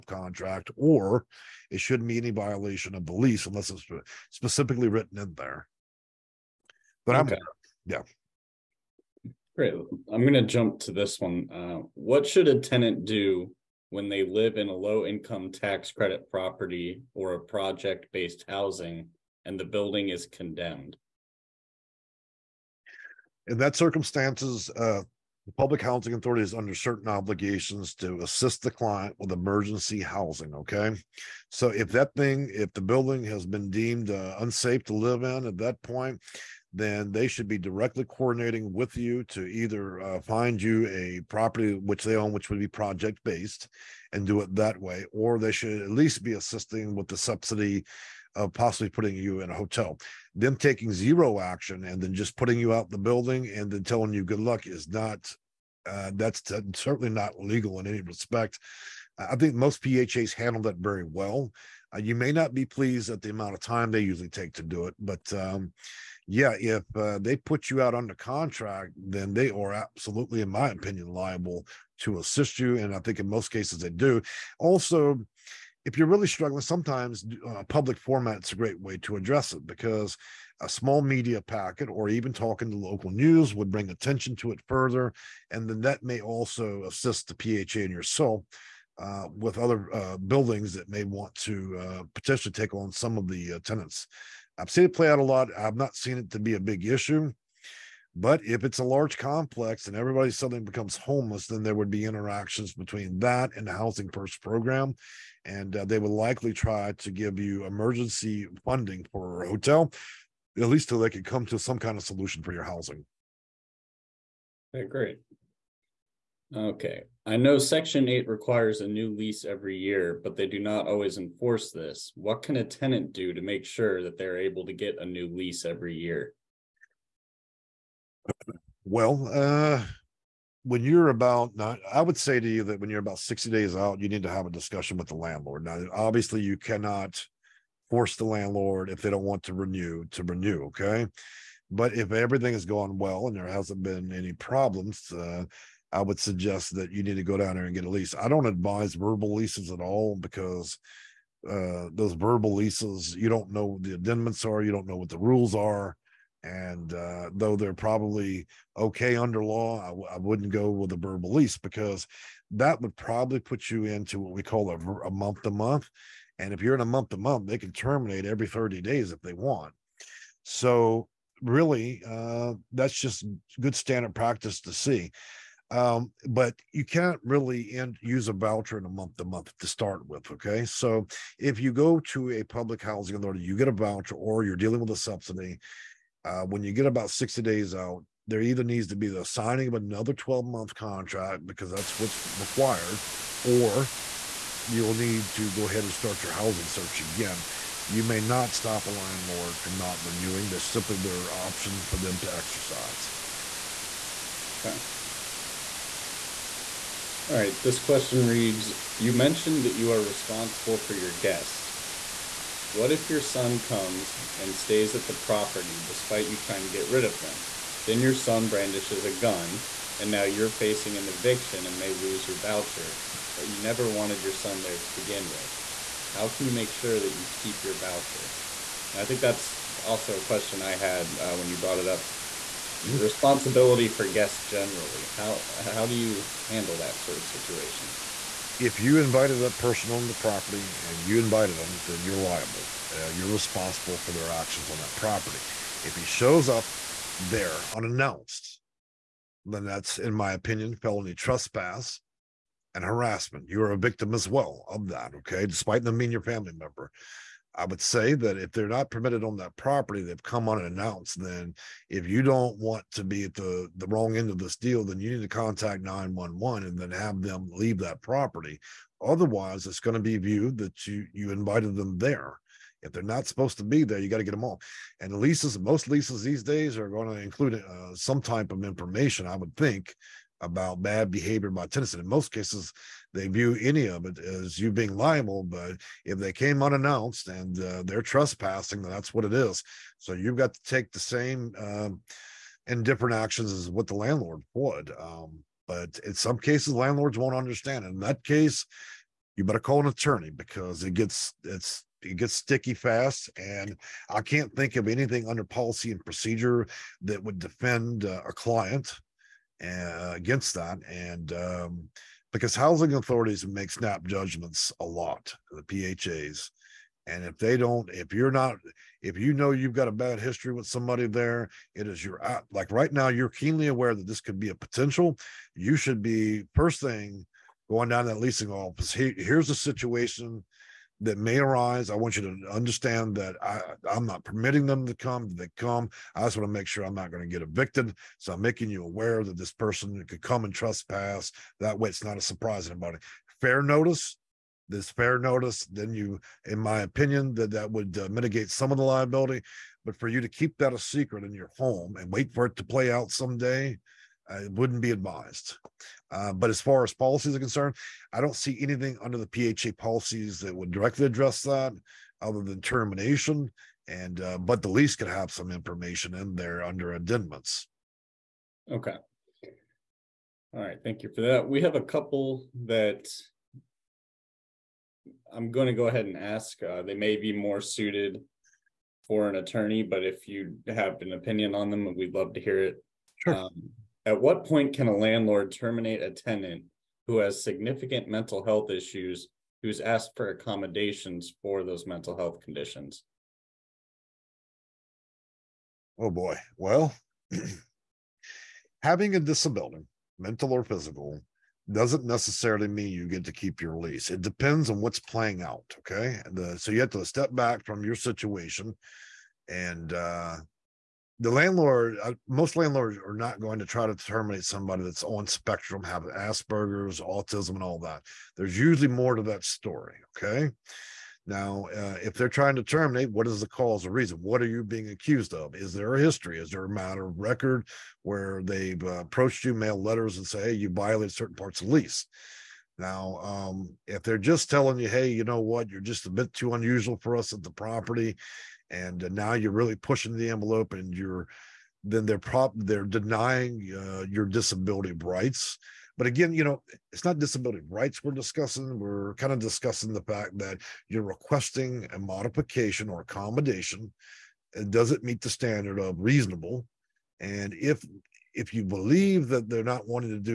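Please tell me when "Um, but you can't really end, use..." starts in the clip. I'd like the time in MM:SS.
02:55.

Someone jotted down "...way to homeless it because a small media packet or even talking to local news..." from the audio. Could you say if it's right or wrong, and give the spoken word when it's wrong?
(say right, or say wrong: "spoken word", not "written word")
wrong: "address", not "homeless".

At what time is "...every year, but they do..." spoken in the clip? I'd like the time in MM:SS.
01:59.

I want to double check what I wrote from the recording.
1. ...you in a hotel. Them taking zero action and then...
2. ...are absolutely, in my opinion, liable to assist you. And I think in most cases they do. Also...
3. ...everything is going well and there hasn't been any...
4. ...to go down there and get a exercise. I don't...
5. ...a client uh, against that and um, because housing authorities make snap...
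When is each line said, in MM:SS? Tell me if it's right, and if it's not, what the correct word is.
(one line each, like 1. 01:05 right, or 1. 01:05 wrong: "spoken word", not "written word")
1. 00:49 right
2. 01:09 right
3. 02:22 right
4. 02:27 wrong: "lease", not "exercise"
5. 05:08 right.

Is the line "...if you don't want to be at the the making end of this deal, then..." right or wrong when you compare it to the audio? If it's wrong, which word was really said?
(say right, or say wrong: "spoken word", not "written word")
wrong: "wrong", not "making".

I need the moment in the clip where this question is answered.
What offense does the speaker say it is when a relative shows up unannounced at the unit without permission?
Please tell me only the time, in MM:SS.
04:10.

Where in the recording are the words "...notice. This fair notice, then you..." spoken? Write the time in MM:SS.
05:43.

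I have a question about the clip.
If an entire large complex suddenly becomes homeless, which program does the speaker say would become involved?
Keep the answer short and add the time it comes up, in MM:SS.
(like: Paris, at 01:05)
housing first program, at 01:43.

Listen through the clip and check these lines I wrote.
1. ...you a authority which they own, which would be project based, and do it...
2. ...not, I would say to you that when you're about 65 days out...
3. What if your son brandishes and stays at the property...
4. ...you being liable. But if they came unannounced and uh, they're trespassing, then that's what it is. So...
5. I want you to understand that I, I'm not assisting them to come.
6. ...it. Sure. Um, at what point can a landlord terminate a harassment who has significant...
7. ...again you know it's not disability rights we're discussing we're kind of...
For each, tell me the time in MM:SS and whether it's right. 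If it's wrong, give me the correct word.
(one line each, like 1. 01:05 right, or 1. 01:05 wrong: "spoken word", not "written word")
1. 00:40 wrong: "property", not "authority"
2. 02:11 wrong: "60", not "65"
3. 03:32 wrong: "comes", not "brandishes"
4. 04:44 right
5. 05:31 wrong: "permitting", not "assisting"
6. 06:22 wrong: "tenant", not "harassment"
7. 07:26 right.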